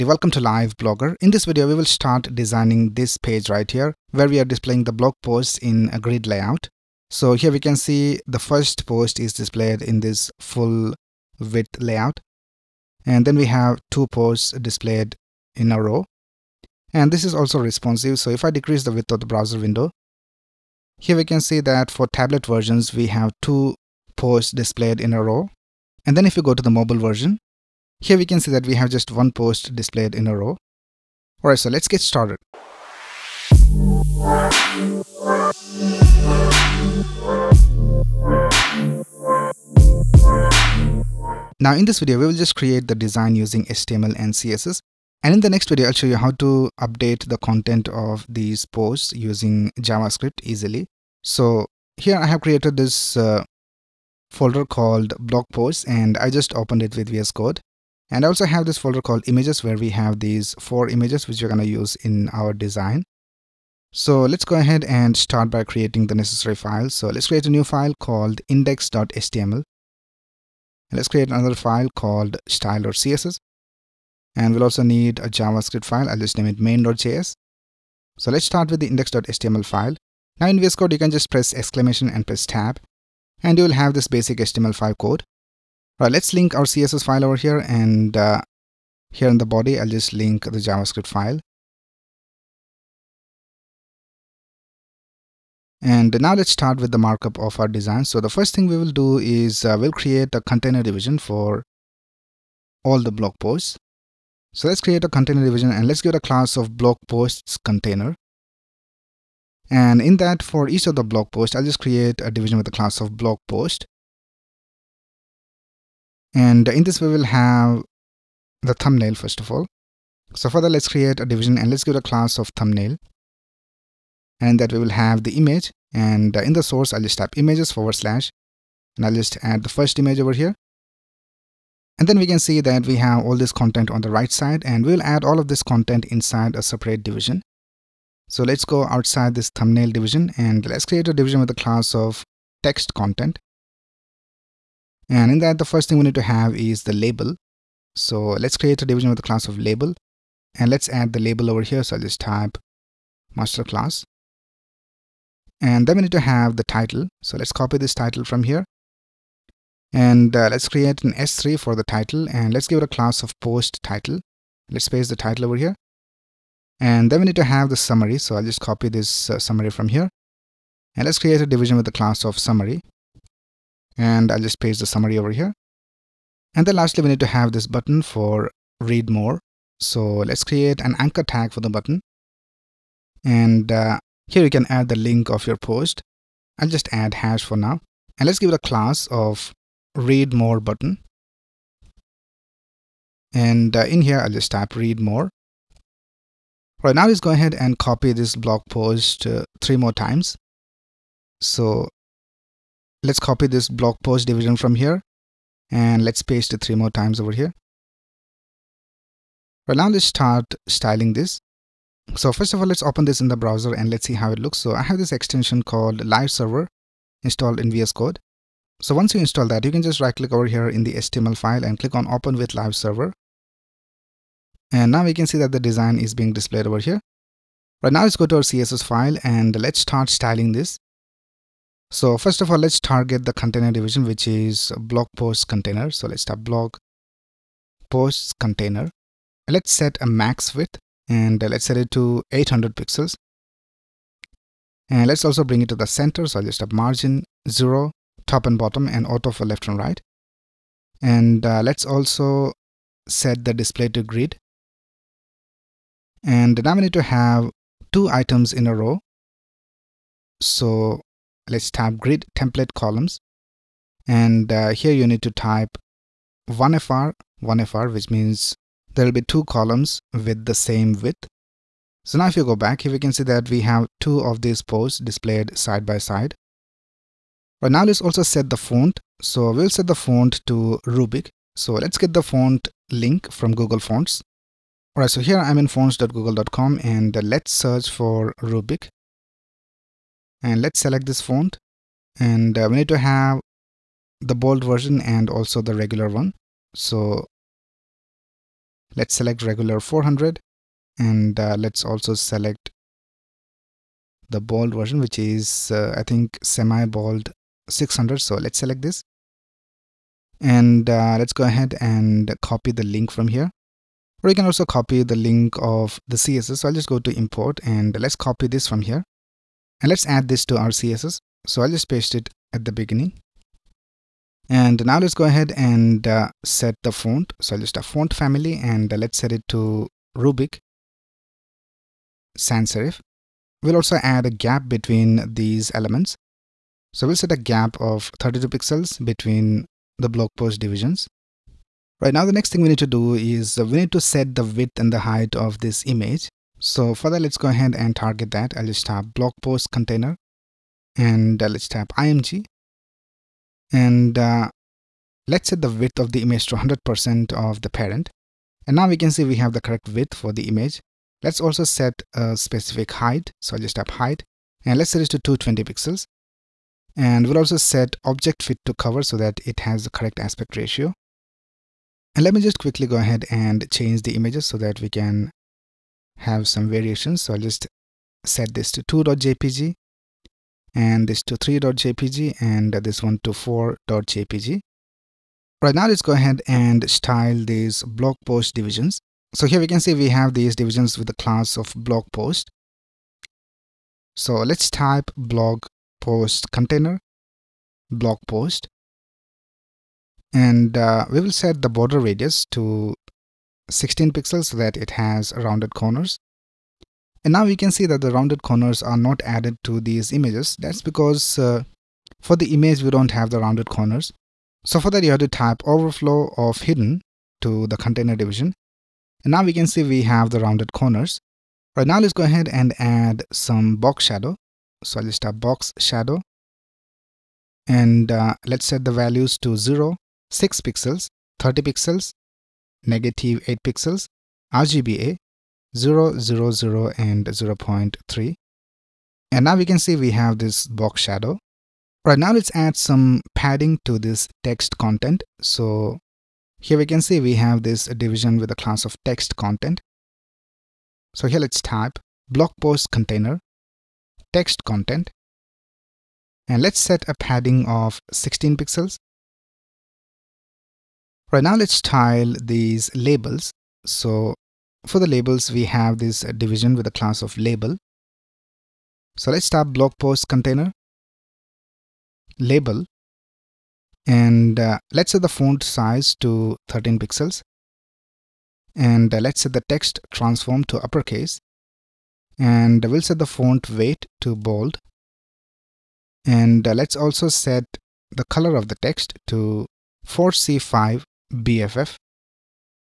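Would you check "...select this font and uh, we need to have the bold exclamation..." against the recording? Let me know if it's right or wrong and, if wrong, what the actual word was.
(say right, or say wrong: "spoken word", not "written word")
wrong: "version", not "exclamation".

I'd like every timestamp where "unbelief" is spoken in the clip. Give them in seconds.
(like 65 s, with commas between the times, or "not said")
not said.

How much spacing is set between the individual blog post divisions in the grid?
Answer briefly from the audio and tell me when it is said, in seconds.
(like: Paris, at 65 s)
32 pixels, at 338 s.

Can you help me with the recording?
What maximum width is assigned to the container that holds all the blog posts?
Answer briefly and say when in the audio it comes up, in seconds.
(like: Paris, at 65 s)
800 pixels, at 242 s.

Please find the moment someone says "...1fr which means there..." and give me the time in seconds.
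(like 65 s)
267 s.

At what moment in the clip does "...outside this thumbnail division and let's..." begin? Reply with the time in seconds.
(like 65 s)
138 s.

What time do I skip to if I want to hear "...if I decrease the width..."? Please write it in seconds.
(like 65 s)
18 s.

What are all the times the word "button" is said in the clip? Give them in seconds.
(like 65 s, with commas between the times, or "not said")
177 s, 181 s, 190 s.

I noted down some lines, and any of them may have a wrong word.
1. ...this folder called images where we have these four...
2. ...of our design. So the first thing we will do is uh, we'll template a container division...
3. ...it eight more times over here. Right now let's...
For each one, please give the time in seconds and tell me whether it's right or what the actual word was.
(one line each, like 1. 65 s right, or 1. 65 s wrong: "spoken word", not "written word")
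1. 58 s right
2. 97 s wrong: "create", not "template"
3. 206 s wrong: "three", not "eight".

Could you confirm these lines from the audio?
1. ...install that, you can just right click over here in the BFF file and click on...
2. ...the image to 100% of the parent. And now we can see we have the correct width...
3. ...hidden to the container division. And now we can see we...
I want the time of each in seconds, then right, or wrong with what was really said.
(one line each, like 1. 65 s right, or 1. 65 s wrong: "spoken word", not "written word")
1. 219 s wrong: "HTML", not "BFF"
2. 356 s right
3. 416 s right.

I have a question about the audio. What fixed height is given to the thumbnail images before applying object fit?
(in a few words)
220 pixels.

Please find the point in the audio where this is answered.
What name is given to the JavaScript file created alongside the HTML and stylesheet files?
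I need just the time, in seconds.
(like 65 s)
76 s.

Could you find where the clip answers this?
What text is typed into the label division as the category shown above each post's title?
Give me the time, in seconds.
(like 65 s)
153 s.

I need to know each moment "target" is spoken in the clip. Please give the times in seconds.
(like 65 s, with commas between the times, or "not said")
232 s, 347 s.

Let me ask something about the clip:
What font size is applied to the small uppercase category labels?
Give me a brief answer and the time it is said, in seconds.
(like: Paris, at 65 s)
13 pixels, at 476 s.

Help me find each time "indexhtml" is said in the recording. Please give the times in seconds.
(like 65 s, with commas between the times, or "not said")
68 s, 78 s.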